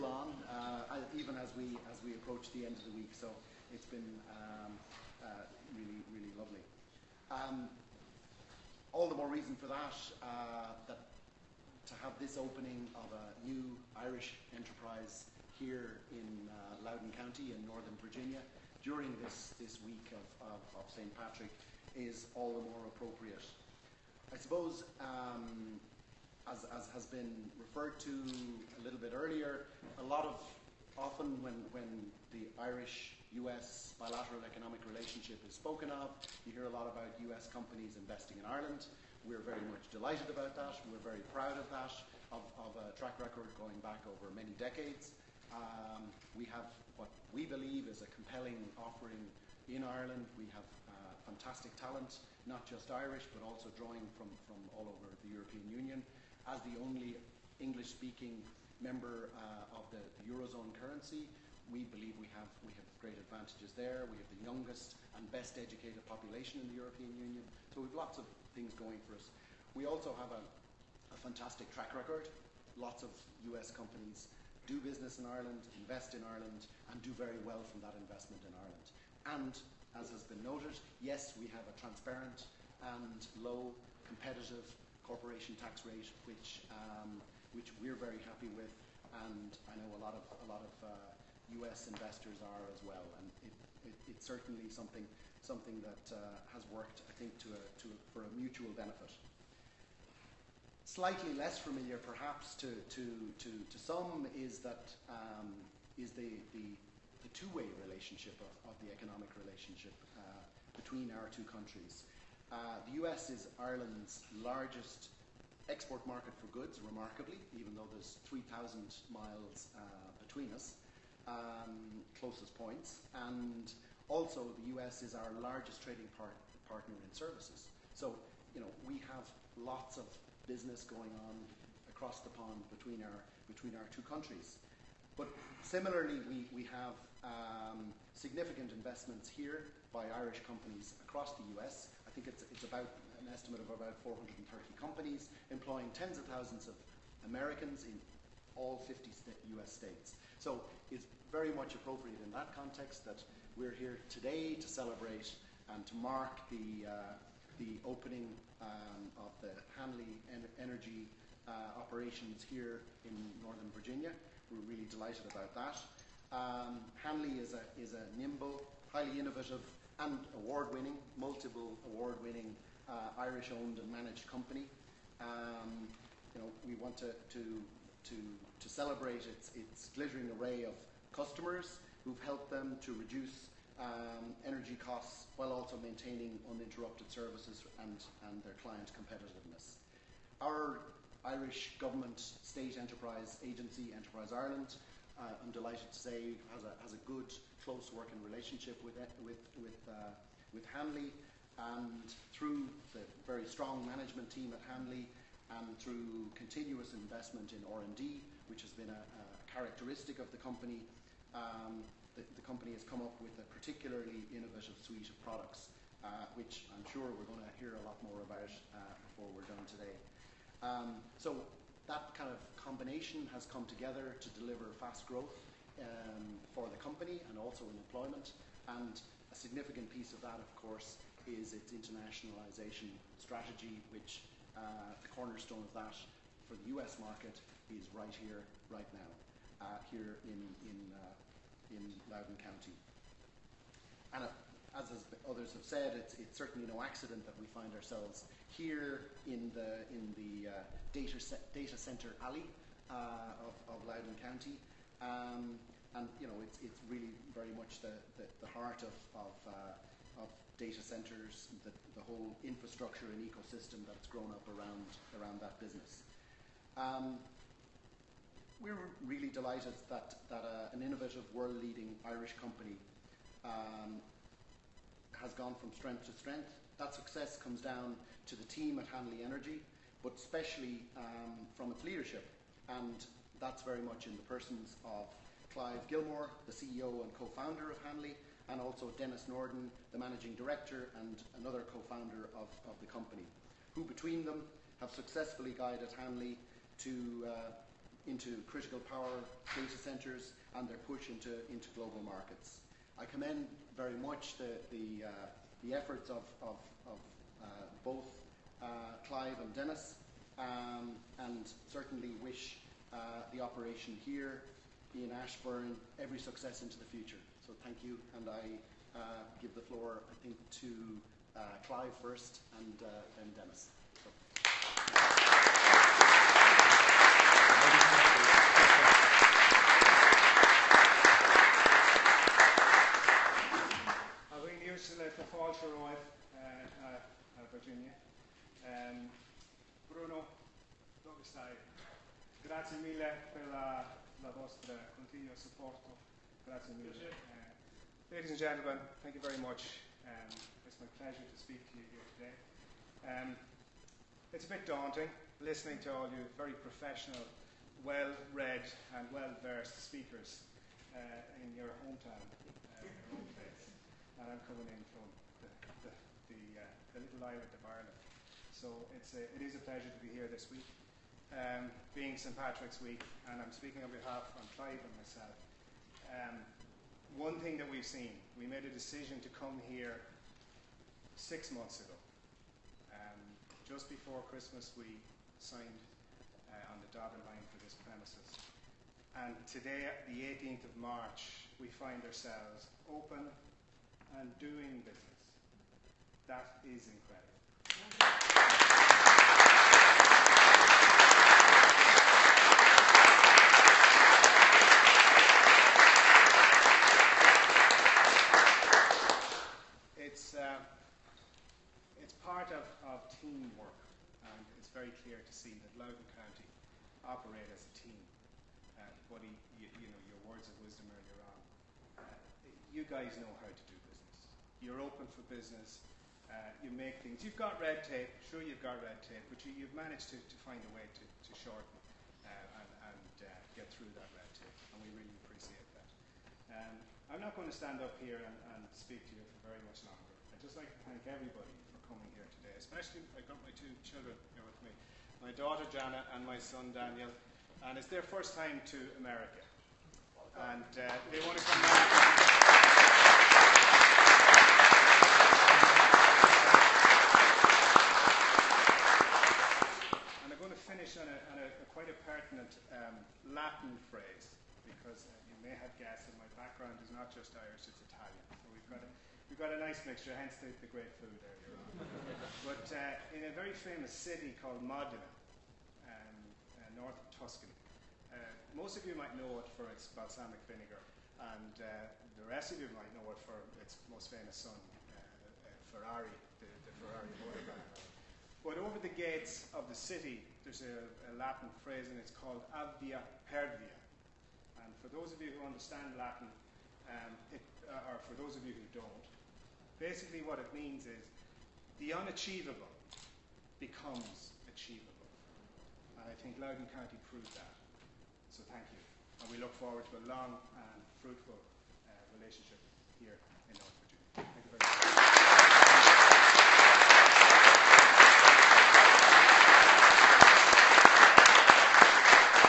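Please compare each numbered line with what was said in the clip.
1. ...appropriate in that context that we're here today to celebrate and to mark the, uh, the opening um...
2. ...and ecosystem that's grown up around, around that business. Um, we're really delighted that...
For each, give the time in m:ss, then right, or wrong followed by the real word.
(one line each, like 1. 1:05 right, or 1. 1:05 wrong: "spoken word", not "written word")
1. 2:31 right
2. 4:23 right.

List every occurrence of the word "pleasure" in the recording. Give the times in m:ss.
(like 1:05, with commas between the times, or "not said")
5:50, 6:09.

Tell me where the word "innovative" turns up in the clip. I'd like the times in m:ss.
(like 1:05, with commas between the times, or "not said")
2:49, 3:34, 4:30.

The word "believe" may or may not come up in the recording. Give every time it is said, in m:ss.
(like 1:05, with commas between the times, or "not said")
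0:47, 1:01.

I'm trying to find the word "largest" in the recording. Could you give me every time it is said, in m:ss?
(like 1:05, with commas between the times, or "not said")
1:54, 2:05.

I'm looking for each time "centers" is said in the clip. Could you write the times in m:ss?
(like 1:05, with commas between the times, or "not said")
4:11, 4:20, 4:59.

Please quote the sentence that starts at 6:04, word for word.
And I'm coming in from the, the, the, uh, the little island of Ireland.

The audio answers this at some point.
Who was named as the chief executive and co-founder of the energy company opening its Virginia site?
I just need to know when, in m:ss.
4:45.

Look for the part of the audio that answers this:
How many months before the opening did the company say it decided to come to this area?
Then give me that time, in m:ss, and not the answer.
6:21.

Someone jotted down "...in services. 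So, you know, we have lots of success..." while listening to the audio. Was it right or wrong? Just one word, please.
wrong.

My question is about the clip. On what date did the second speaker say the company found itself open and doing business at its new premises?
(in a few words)
18 March.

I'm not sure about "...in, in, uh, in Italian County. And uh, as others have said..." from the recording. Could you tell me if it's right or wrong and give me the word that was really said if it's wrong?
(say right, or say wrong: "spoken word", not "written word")
wrong: "Loudoun", not "Italian".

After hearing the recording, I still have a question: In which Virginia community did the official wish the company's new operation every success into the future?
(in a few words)
Ashburn.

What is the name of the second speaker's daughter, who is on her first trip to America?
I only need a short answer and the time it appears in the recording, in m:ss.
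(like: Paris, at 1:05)
Jana, at 7:25.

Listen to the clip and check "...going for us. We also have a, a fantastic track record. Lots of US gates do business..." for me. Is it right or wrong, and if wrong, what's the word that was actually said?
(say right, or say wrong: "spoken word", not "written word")
wrong: "companies", not "gates".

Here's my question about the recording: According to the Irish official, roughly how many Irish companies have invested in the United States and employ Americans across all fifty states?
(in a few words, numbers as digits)
430.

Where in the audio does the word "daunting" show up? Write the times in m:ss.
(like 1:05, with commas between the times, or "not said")
5:54.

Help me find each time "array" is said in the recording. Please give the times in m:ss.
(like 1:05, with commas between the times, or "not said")
3:00.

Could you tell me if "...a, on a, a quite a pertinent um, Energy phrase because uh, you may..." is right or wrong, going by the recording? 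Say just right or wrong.
wrong.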